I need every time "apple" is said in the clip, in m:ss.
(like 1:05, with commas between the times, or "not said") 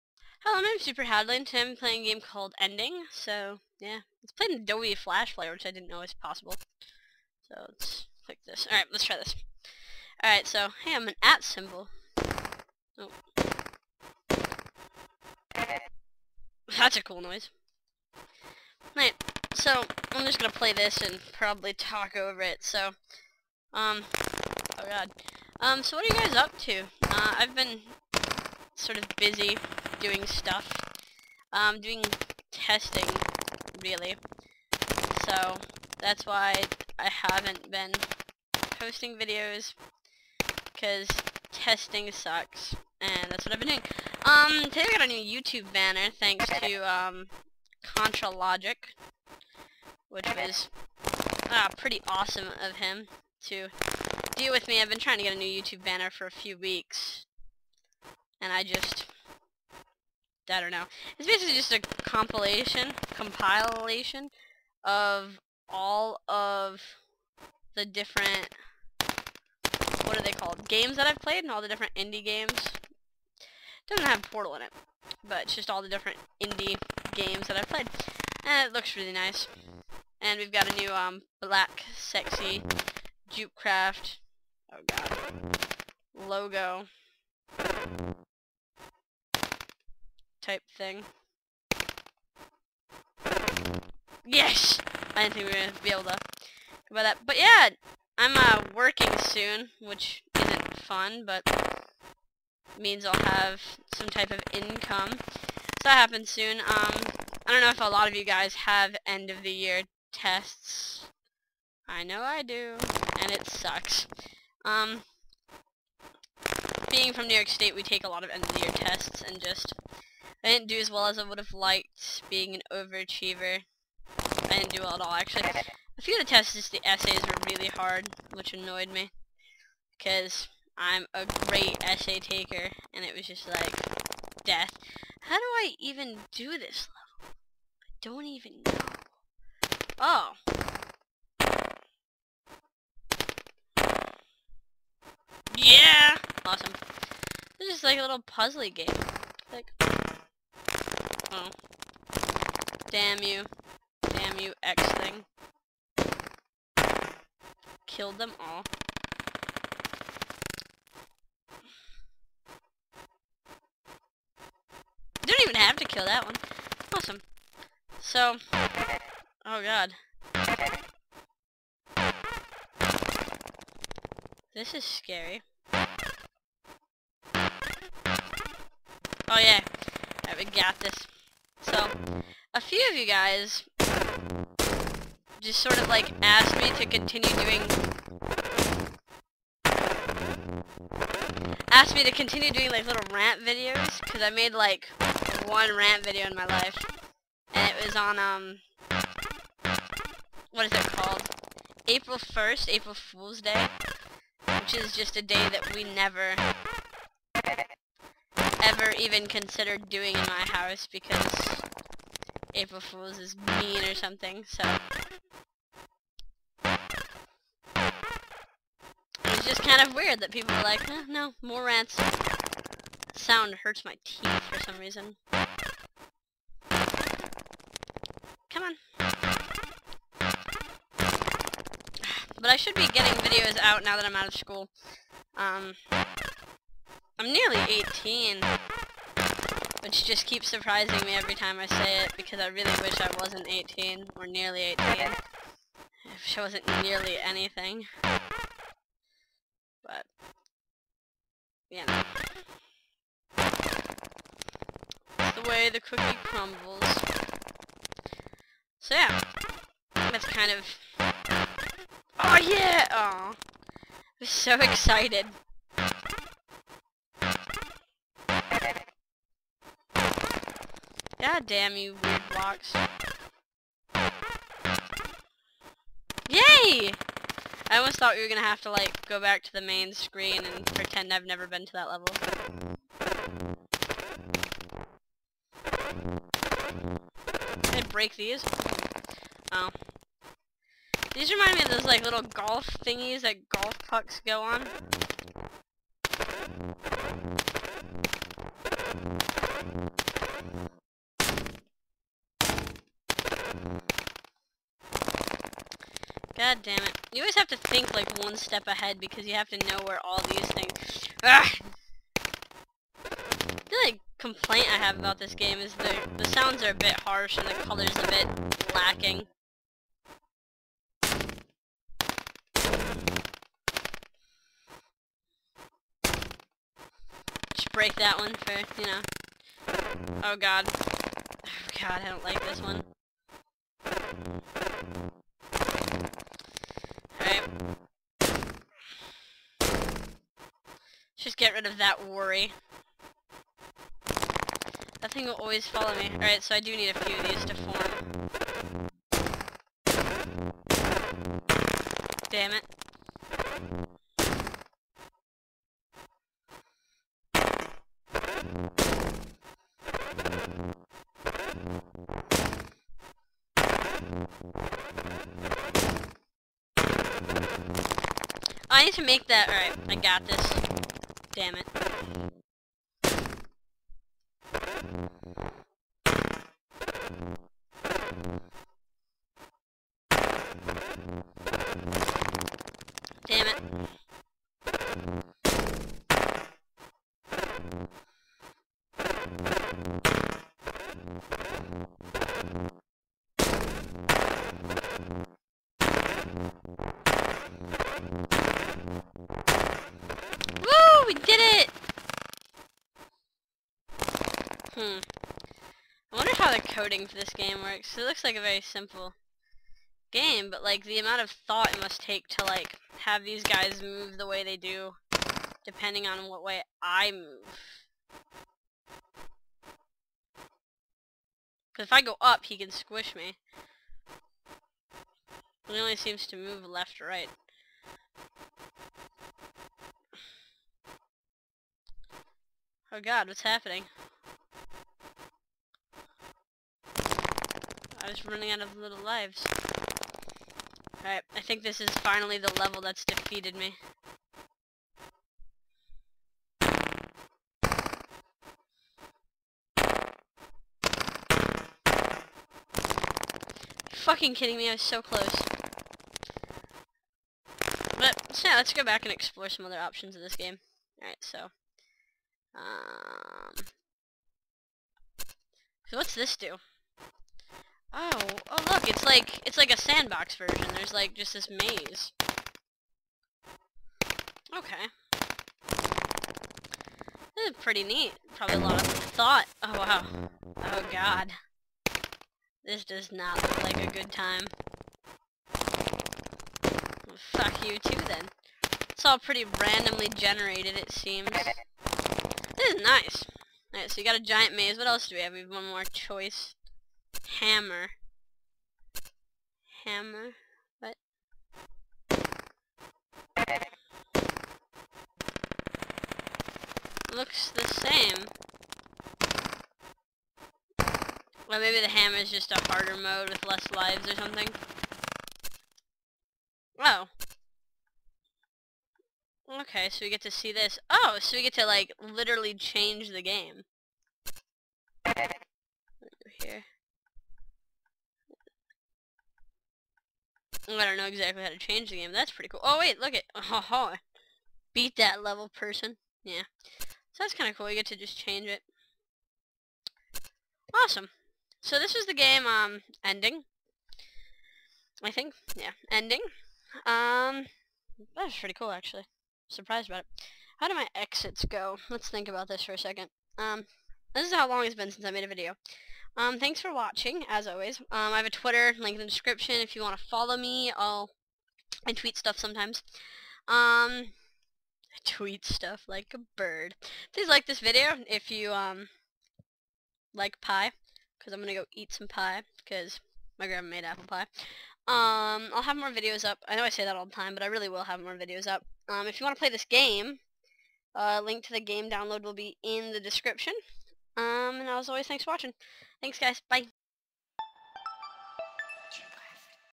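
9:33.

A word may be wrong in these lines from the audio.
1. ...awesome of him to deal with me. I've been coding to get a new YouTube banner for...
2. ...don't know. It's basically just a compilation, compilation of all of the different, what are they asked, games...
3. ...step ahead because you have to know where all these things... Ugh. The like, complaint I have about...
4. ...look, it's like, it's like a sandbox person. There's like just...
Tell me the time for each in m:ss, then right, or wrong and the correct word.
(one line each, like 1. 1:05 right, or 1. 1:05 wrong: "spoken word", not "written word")
1. 0:52 wrong: "trying", not "coding"
2. 1:00 wrong: "called", not "asked"
3. 5:08 right
4. 7:48 wrong: "version", not "person".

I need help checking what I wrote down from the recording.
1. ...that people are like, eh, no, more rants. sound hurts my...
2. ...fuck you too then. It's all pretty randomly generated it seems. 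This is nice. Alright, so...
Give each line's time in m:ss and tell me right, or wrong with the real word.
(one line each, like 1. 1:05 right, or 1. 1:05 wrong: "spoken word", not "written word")
1. 3:40 right
2. 8:07 right.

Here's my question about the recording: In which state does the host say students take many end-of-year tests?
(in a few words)
New York State.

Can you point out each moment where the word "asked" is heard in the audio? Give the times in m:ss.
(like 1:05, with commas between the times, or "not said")
3:06, 3:11.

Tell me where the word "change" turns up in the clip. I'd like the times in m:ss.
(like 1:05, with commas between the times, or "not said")
8:42, 8:51, 8:58.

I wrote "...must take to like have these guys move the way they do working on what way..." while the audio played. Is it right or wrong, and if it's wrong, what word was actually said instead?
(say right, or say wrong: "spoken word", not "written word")
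wrong: "depending", not "working".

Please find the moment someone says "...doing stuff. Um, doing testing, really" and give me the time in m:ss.
0:30.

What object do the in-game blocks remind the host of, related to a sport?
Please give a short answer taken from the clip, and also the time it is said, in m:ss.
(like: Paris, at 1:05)
golf thingies, at 4:52.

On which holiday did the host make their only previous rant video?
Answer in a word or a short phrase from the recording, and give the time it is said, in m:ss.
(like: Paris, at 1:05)
April Fool's Day, at 3:22.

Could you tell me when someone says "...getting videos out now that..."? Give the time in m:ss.
3:52.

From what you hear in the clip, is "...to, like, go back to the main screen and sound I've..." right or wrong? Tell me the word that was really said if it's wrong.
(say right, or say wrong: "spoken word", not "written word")
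wrong: "pretend", not "sound".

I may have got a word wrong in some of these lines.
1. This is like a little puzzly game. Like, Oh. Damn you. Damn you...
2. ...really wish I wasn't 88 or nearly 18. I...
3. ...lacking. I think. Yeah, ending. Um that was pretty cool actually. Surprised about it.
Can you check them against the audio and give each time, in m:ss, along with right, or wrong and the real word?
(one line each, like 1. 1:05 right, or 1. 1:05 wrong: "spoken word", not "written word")
1. 2:27 right
2. 4:02 wrong: "18", not "88"
3. 9:03 wrong: "ending", not "lacking".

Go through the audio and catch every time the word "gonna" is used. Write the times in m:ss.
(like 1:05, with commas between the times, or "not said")
0:20, 4:38.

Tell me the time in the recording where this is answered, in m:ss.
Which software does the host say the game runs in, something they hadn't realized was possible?
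0:04.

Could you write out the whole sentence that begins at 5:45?
That thing will always follow me.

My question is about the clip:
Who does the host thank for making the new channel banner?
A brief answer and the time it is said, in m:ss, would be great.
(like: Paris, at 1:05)
Contra Logic, at 0:47.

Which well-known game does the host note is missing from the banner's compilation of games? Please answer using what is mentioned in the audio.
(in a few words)
Portal.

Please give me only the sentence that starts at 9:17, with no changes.
Um, I have a Twitter, link in the description.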